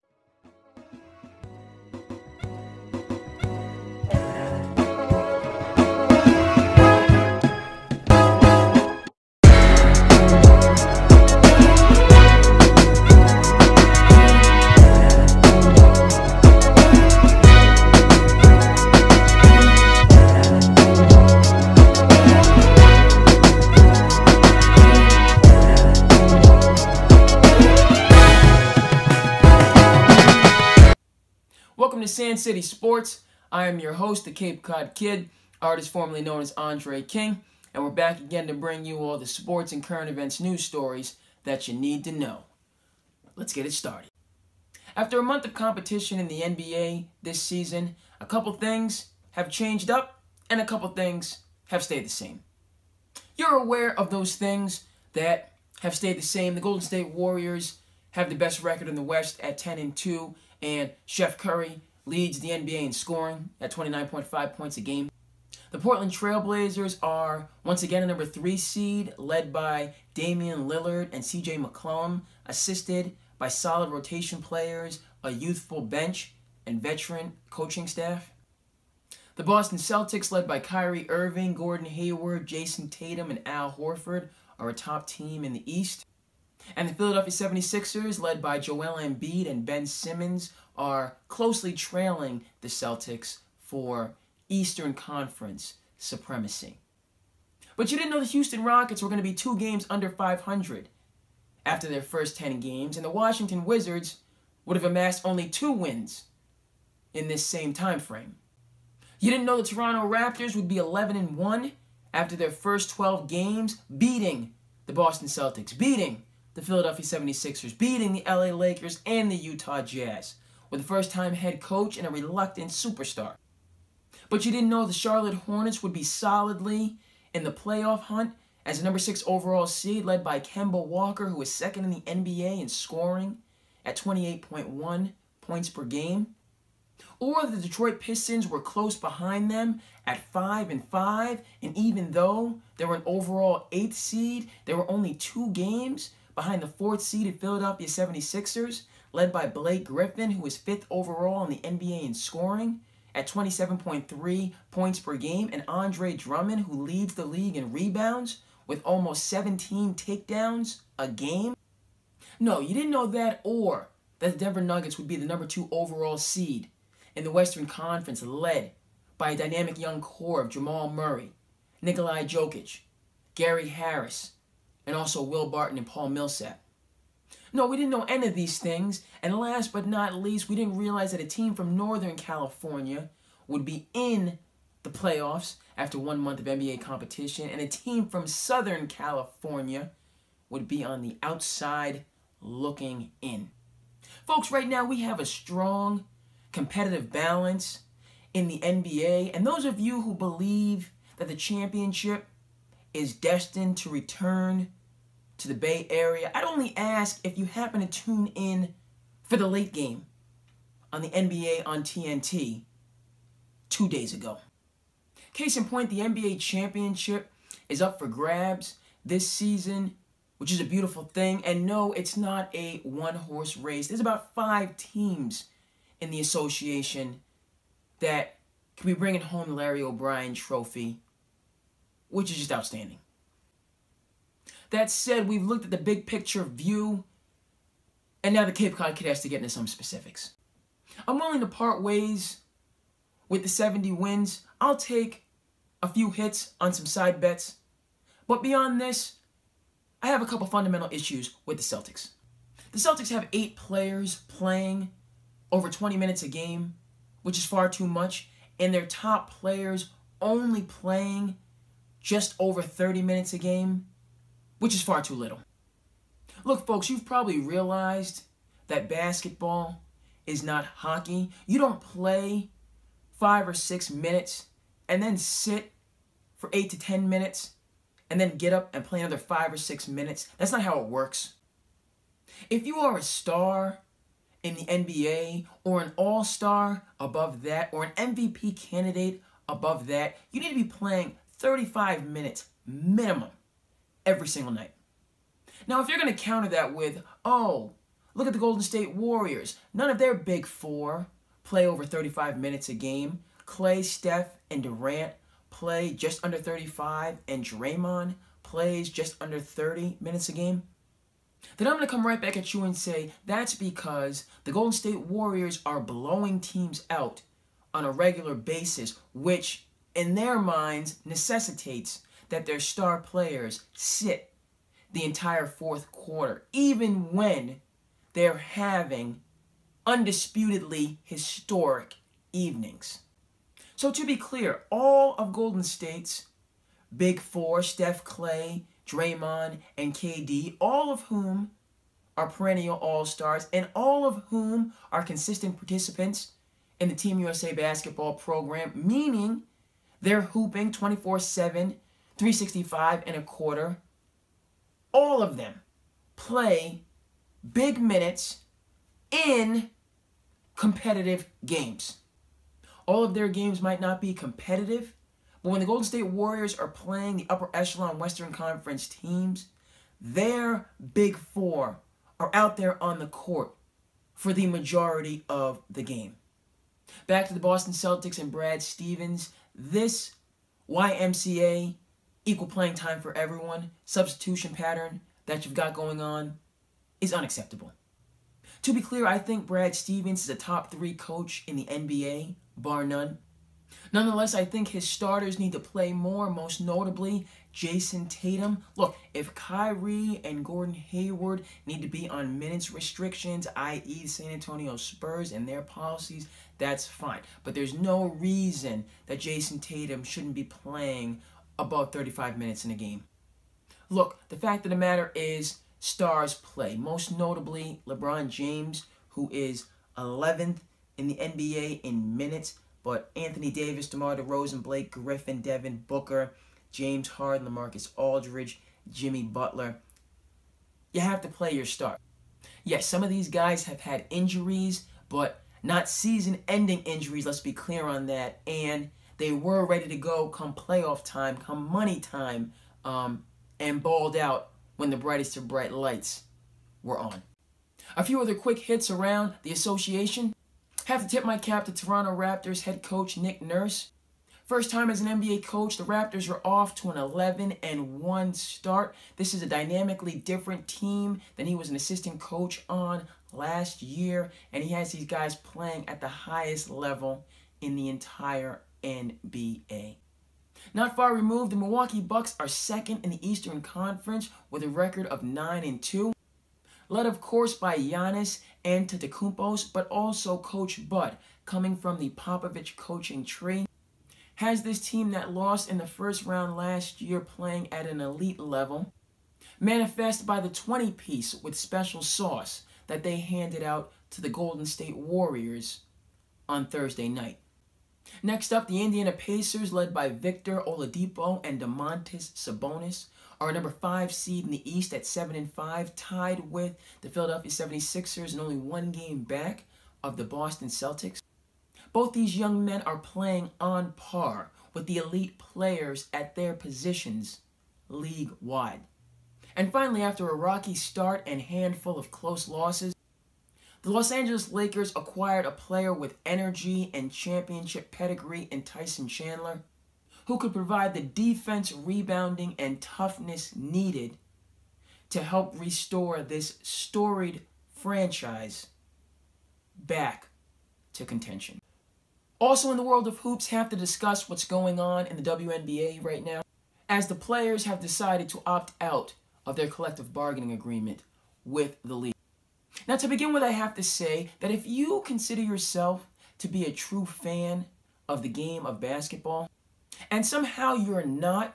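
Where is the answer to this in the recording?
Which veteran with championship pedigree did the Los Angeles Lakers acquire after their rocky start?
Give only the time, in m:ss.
8:48.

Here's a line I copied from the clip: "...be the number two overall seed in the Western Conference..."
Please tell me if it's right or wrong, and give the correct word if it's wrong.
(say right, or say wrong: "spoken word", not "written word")
right.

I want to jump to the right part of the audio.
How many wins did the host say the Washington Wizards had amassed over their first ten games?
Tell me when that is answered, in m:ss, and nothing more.
1:45.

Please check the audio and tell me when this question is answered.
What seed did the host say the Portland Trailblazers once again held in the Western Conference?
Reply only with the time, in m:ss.
1:08.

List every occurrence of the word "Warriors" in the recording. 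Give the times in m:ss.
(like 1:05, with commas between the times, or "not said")
0:57, 4:58, 5:15, 6:06, 8:14.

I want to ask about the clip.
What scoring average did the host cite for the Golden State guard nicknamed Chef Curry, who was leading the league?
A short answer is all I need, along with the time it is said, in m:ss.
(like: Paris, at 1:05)
29.5, at 1:03.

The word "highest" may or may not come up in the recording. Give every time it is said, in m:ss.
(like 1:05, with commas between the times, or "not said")
7:46.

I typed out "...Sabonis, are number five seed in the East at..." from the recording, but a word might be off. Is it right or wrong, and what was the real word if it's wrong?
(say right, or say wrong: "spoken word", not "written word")
right.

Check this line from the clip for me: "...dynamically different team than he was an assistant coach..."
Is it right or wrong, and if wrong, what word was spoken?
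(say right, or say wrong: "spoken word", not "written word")
right.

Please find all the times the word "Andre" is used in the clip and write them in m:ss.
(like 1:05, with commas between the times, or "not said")
0:36, 2:35.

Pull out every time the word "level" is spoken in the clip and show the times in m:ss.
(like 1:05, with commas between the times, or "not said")
7:46, 8:08.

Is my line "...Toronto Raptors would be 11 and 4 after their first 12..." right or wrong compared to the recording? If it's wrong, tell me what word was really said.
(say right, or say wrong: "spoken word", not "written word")
wrong: "1", not "4".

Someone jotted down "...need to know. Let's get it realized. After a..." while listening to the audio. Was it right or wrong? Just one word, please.
wrong.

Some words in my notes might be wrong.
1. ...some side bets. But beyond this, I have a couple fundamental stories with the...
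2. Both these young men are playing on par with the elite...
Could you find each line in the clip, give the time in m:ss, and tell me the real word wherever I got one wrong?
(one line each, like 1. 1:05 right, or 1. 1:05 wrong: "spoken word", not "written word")
1. 4:06 wrong: "issues", not "stories"
2. 8:31 right.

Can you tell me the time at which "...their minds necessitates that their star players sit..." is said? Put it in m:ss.
5:20.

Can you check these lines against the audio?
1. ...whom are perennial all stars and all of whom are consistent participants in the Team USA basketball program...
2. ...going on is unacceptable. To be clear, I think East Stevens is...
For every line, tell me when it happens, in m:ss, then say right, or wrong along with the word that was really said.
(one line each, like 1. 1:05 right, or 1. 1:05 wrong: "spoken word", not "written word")
1. 5:41 right
2. 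6:25 wrong: "Brad", not "East".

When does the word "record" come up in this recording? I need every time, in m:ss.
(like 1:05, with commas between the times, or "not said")
0:58, 7:54.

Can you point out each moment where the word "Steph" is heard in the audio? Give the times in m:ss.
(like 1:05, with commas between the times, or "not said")
5:03, 5:37.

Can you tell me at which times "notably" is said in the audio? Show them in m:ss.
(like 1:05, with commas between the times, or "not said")
6:36, 6:57.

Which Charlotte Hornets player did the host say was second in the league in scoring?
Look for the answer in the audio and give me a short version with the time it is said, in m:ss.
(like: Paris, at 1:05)
Kemba Walker, at 2:10.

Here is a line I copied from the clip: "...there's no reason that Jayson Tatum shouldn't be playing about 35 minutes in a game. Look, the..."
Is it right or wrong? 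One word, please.
right.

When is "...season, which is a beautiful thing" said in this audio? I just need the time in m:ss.
3:39.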